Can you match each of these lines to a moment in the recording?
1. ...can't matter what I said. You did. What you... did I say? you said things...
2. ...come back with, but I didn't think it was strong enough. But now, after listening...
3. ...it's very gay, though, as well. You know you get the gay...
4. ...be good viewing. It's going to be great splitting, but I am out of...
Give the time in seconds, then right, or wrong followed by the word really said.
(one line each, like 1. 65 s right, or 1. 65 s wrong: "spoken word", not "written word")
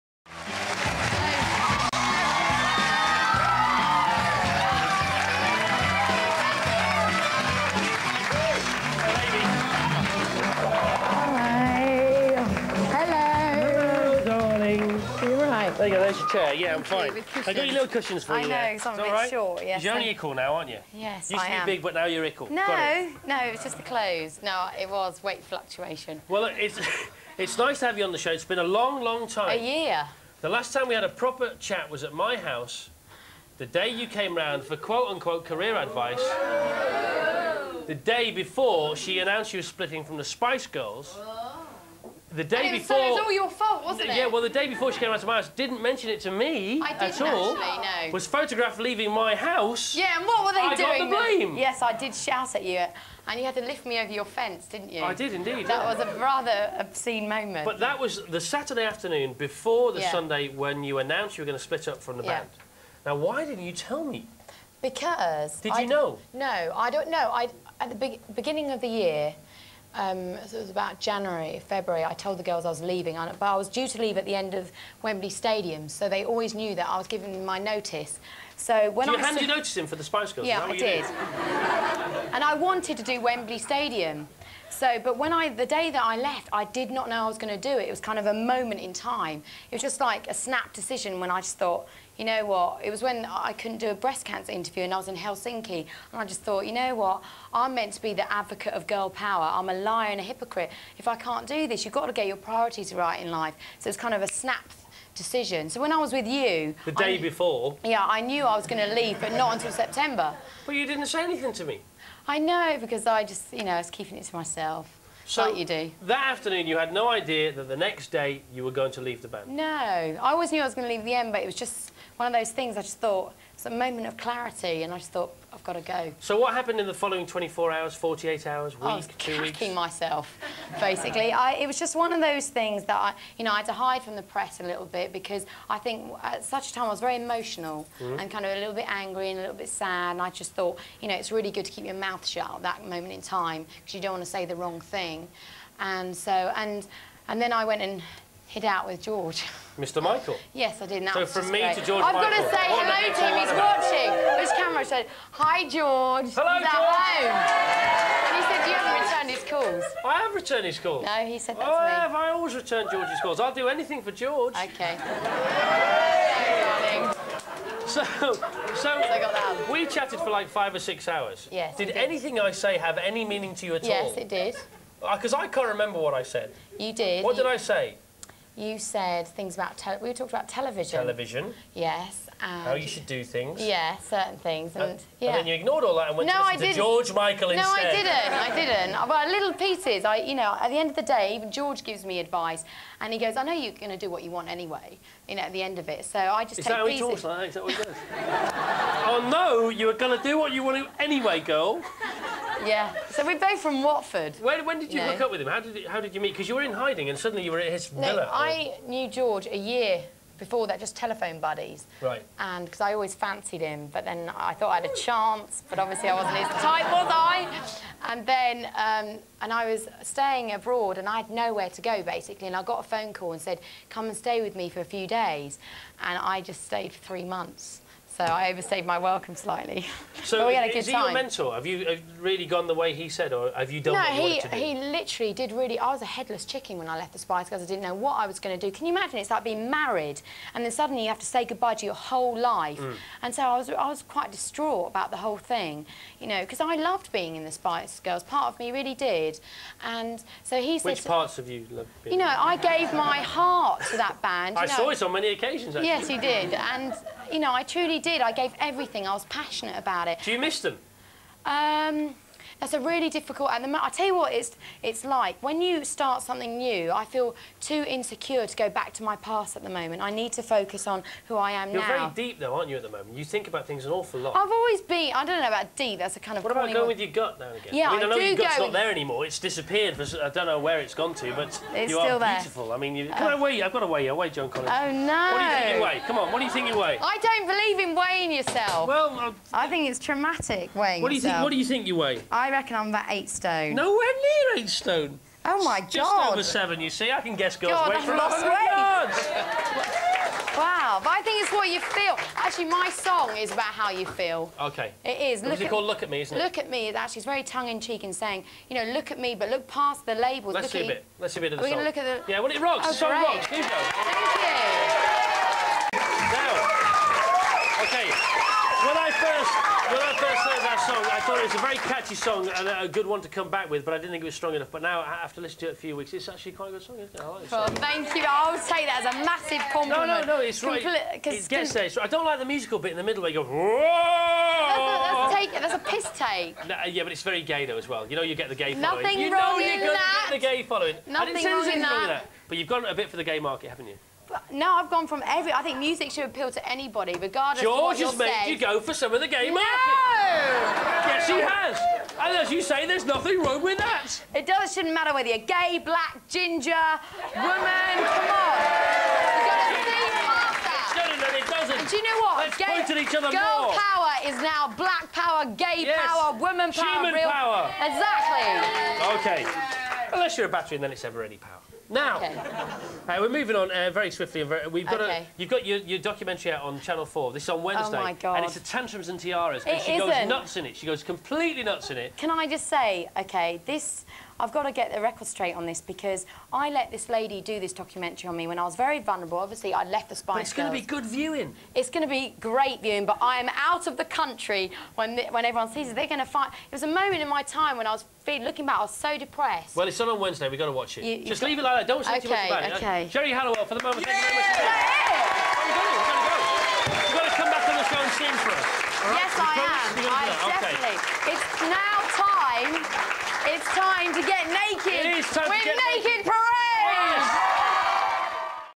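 1. 175 s wrong: "remember", not "matter"
2. 323 s right
3. 337 s right
4. 390 s wrong: "viewing", not "splitting".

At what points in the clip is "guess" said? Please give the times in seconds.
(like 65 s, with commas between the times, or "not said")
297 s.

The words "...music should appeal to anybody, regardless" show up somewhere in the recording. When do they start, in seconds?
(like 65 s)
345 s.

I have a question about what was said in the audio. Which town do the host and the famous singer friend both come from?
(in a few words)
Watford.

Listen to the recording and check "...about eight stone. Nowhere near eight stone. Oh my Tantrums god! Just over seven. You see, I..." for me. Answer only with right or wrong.
wrong.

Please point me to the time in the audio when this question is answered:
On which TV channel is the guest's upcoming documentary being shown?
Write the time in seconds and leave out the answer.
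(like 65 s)
376 s.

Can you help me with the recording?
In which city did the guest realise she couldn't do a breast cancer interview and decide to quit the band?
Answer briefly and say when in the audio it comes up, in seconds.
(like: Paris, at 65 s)
Helsinki, at 95 s.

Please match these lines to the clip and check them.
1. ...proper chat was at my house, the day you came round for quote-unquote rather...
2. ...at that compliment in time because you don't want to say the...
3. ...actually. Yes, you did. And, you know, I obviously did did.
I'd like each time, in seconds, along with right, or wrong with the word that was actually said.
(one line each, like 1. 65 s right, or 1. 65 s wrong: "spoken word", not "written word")
1. 31 s wrong: "career", not "rather"
2. 142 s wrong: "moment", not "compliment"
3. 255 s wrong: "truly", not "obviously".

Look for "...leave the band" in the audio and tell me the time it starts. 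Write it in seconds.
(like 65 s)
119 s.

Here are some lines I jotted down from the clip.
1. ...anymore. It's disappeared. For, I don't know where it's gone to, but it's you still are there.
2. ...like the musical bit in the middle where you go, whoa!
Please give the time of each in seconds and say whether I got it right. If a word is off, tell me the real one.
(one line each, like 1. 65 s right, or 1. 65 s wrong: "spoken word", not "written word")
1. 278 s right
2. 332 s right.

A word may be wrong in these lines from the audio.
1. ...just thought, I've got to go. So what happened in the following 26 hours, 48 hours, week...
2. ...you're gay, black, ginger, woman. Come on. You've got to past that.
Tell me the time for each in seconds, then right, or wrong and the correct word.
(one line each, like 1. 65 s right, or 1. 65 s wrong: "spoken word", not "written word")
1. 124 s wrong: "24", not "26"
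2. 355 s right.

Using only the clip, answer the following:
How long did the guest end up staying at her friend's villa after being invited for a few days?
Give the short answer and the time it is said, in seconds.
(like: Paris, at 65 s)
3 months, at 227 s.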